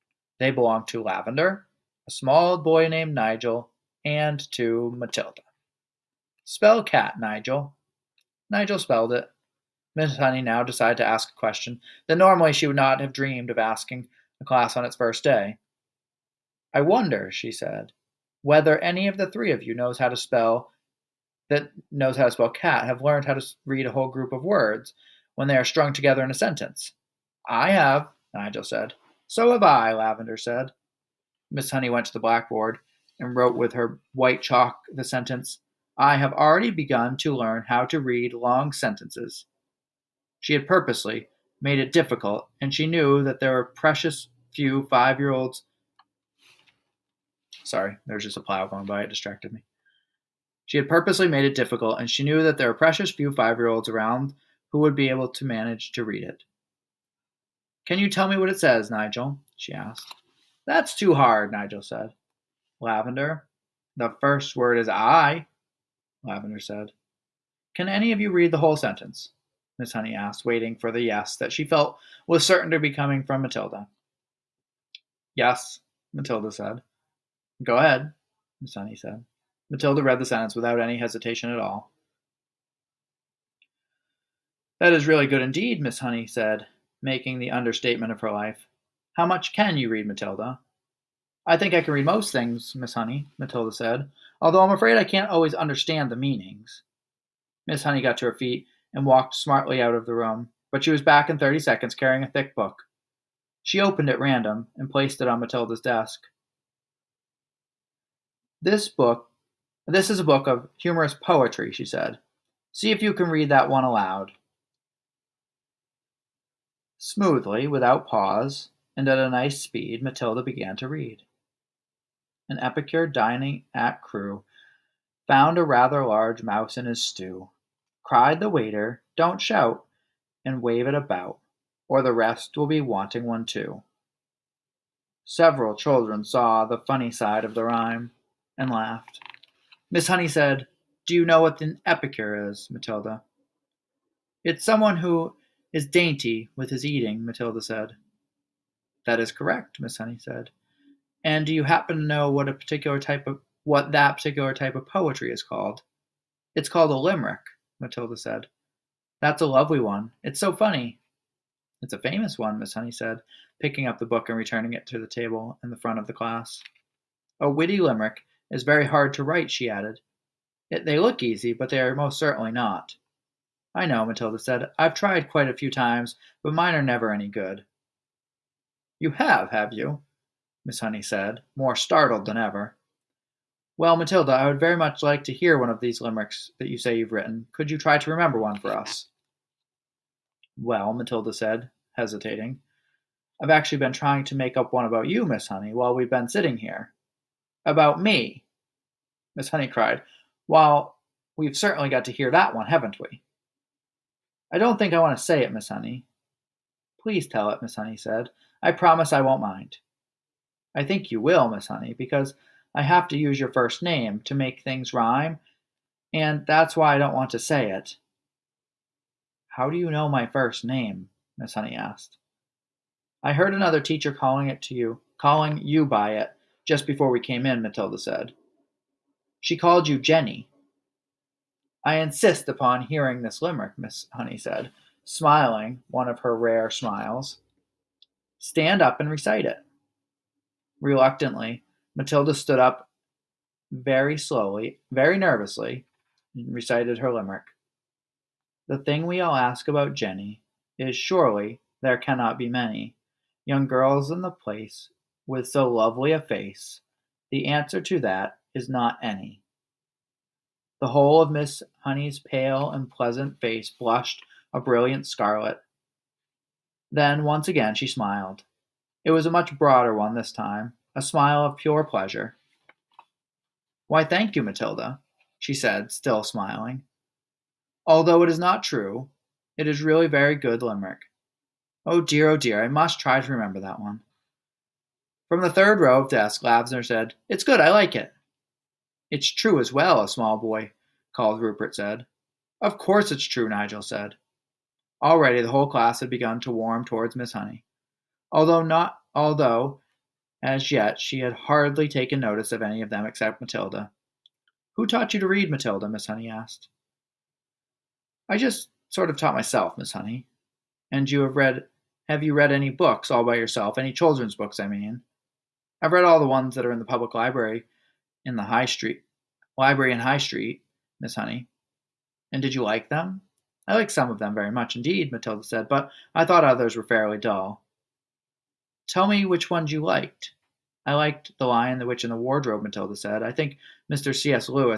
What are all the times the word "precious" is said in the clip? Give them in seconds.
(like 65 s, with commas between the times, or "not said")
43 s, 52 s.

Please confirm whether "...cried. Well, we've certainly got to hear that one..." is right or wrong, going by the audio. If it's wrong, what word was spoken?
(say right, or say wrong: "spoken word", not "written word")
right.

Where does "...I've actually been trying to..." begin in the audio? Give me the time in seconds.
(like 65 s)
193 s.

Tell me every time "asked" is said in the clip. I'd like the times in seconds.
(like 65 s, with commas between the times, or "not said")
59 s, 70 s, 221 s, 306 s.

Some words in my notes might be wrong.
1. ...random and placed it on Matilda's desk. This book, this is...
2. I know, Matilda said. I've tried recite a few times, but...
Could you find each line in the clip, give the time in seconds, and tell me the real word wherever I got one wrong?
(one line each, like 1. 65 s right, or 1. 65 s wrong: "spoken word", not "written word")
1. 104 s right
2. 173 s wrong: "quite", not "recite".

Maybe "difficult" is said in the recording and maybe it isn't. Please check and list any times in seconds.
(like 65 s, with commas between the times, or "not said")
41 s, 51 s.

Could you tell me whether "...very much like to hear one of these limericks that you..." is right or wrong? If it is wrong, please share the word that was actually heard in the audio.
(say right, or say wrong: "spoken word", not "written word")
right.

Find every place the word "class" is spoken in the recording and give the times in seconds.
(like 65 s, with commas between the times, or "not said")
14 s, 166 s, 295 s.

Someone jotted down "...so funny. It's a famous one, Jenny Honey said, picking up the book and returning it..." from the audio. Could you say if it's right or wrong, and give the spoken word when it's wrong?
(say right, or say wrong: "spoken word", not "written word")
wrong: "Miss", not "Jenny".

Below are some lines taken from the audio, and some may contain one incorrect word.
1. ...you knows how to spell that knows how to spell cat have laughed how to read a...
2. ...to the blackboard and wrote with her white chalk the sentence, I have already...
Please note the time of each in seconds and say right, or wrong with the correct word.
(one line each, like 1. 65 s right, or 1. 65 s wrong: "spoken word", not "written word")
1. 19 s wrong: "learned", not "laughed"
2. 32 s right.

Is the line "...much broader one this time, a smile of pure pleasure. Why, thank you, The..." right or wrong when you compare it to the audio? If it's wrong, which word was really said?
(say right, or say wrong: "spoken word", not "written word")
wrong: "Matilda", not "The".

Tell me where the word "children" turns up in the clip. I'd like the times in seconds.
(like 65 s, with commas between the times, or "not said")
135 s, 313 s.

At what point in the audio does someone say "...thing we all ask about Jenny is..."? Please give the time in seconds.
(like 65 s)
248 s.